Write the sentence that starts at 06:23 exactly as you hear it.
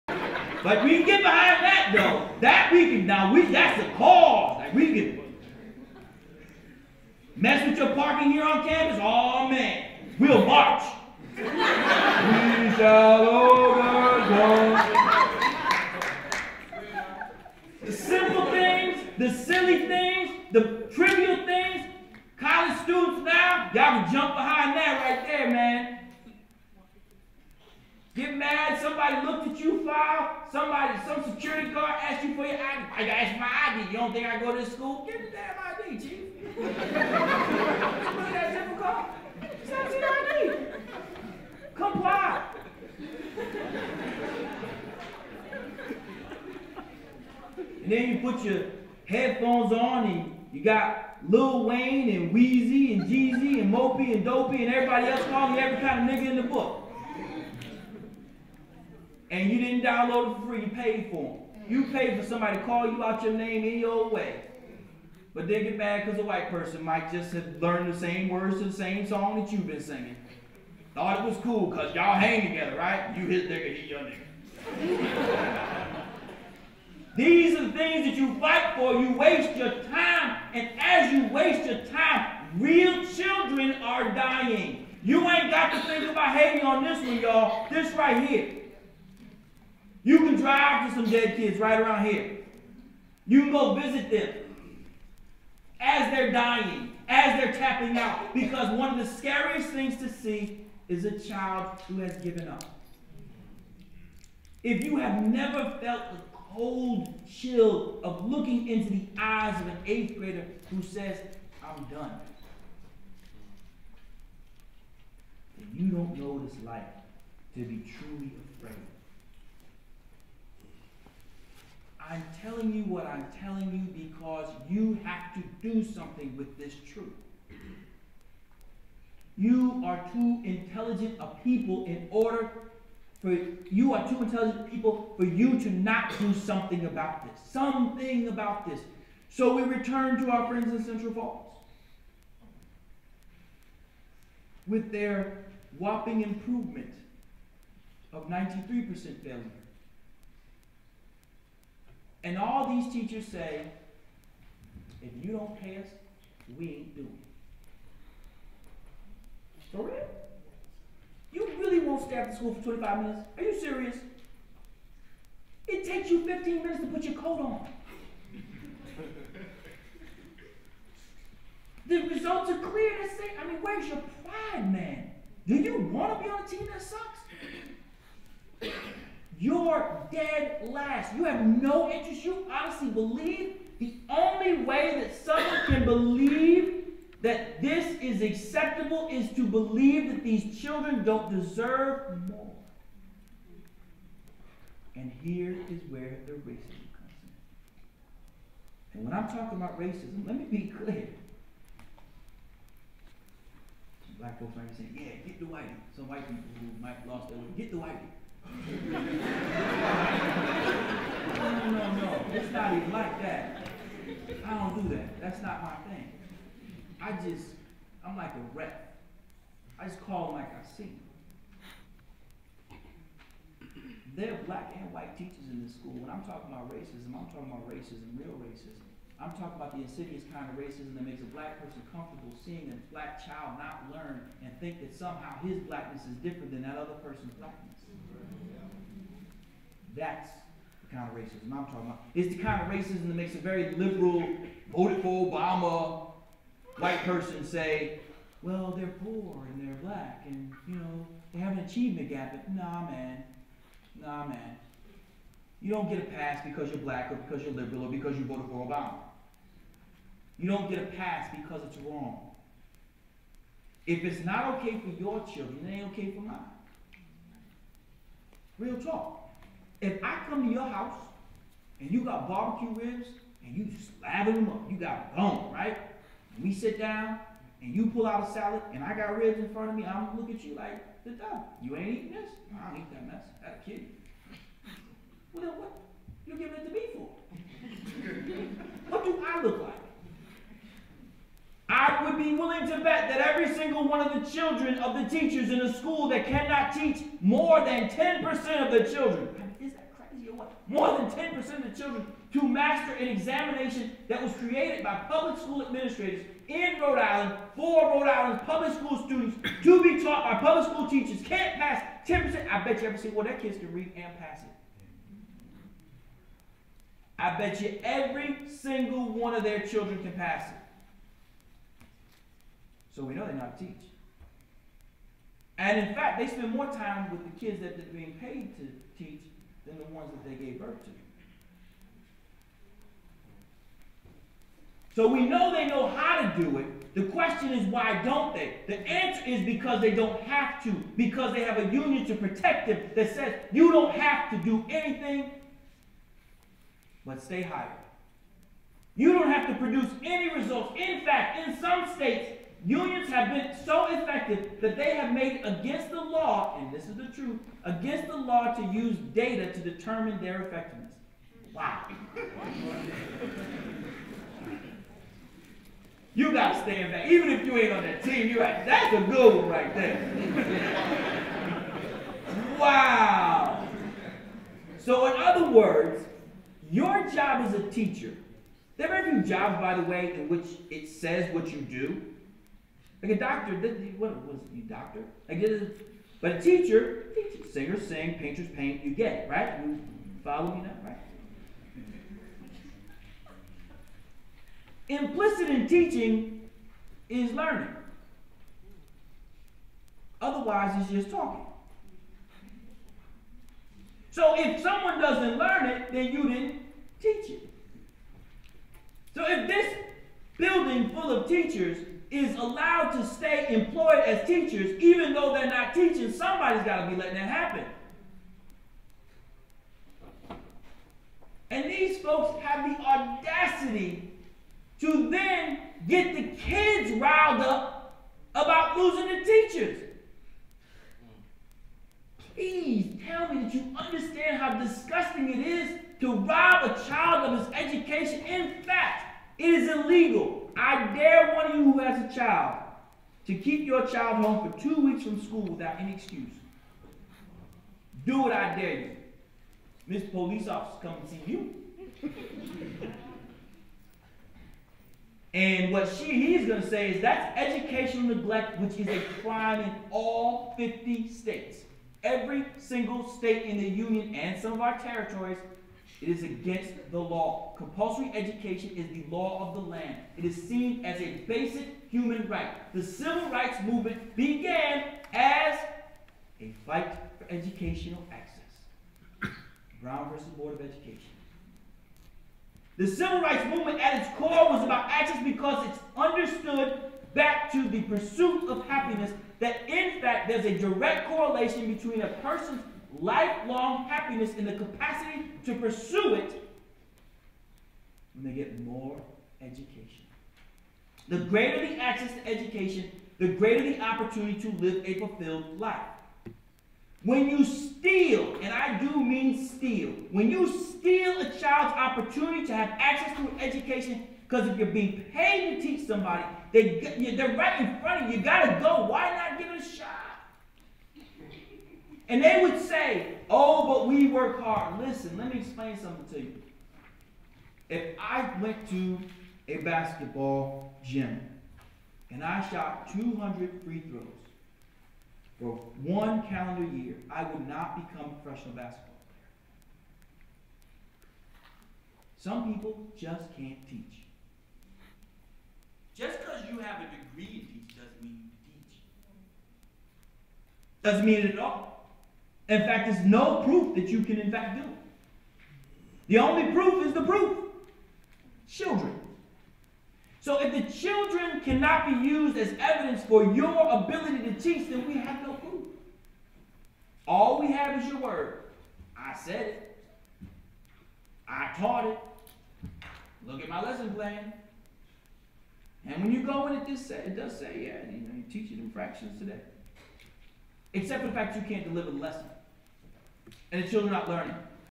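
Like a doctor, what was you doctor?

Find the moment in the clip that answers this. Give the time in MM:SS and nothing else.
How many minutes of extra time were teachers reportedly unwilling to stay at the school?
02:42.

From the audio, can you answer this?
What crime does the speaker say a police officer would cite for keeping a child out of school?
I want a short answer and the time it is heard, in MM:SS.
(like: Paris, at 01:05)
Educational neglect, at 07:37.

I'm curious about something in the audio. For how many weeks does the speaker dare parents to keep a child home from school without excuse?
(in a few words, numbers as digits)
2.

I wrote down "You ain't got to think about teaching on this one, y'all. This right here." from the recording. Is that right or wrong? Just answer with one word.
wrong.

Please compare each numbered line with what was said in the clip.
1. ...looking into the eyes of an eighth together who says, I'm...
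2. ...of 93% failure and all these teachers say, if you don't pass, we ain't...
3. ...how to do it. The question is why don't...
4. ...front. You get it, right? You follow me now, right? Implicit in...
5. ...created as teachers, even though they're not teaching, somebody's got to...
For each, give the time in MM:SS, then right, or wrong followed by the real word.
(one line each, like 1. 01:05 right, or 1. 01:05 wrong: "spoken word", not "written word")
1. 01:48 wrong: "grader", not "together"
2. 02:28 right
3. 05:35 right
4. 06:28 wrong: "paint", not "front"
5. 06:53 wrong: "employed", not "created".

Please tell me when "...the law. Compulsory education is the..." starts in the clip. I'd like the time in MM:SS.
07:46.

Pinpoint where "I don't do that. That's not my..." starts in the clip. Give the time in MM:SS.
03:34.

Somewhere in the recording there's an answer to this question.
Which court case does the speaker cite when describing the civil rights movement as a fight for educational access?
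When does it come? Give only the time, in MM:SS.
07:59.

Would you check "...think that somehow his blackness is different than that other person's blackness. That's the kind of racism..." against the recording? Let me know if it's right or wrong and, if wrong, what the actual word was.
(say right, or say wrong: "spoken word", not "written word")
right.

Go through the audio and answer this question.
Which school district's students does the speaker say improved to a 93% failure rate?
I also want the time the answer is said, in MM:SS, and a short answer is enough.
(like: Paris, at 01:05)
Central Falls, at 02:20.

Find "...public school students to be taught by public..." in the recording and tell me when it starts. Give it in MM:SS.
05:08.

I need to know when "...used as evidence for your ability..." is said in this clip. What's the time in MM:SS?
09:22.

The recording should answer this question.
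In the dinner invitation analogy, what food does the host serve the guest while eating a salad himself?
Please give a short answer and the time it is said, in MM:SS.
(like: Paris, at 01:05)
Barbecue ribs, at 04:32.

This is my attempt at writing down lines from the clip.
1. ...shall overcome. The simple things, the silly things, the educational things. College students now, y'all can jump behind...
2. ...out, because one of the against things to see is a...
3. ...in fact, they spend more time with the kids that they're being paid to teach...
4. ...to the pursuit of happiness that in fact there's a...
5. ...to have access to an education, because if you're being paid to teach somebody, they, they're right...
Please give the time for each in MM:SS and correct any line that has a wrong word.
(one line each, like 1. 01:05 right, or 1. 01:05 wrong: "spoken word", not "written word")
1. 00:12 wrong: "trivial", not "educational"
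2. 01:37 wrong: "scariest", not "against"
3. 05:25 right
4. 08:07 right
5. 08:32 right.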